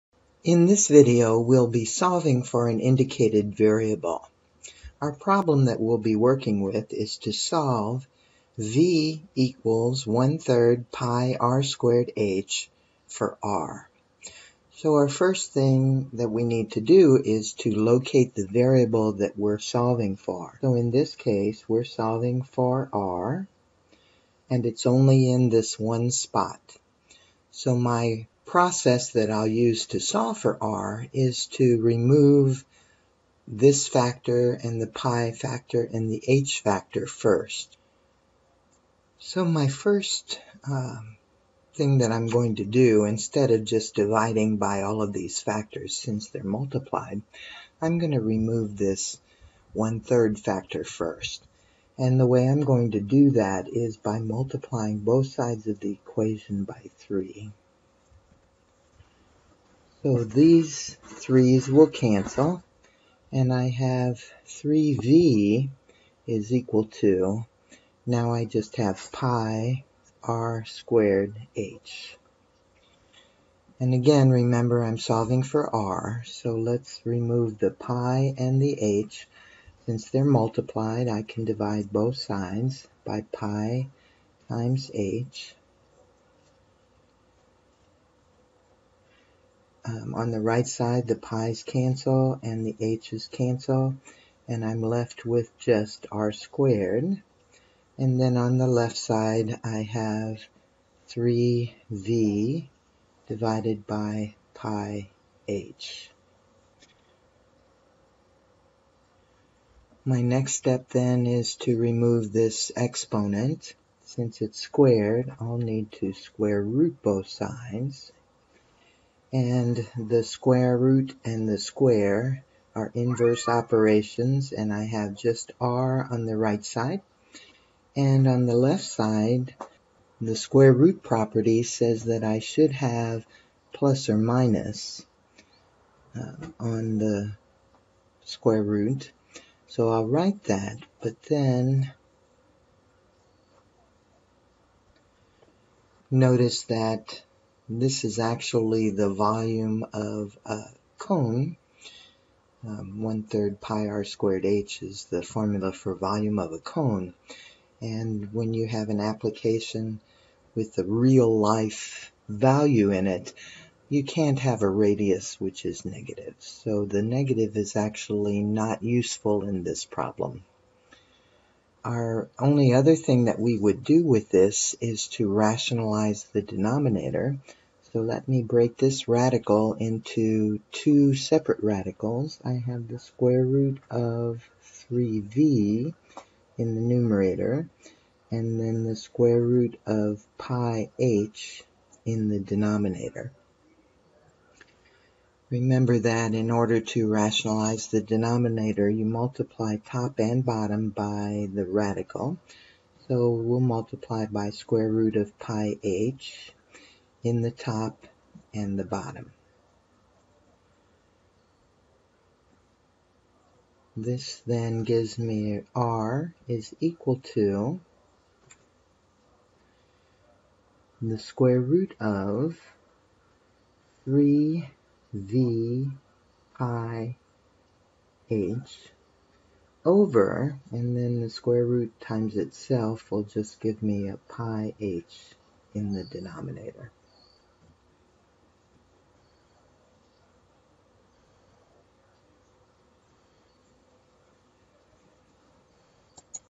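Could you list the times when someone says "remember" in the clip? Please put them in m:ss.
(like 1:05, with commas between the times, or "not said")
1:14, 3:15.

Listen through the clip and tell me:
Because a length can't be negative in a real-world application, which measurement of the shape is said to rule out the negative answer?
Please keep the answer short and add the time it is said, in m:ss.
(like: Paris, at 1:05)
radius, at 2:44.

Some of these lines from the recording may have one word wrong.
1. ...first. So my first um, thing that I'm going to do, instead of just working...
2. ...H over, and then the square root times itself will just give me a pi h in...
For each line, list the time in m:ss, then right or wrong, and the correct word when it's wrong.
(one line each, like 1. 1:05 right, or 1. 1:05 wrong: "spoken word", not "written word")
1. 0:37 wrong: "dividing", not "working"
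2. 3:48 right.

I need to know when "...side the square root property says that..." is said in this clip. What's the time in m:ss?
2:08.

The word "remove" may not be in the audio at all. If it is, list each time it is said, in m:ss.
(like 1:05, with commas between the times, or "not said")
0:31, 0:48, 1:17, 1:51.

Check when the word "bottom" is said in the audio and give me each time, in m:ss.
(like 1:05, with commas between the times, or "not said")
3:20, 3:28.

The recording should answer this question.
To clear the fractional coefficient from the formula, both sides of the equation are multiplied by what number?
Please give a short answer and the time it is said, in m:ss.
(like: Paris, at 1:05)
3, at 0:54.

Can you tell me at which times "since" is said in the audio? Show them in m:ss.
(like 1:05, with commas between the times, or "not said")
0:45, 1:19, 1:54.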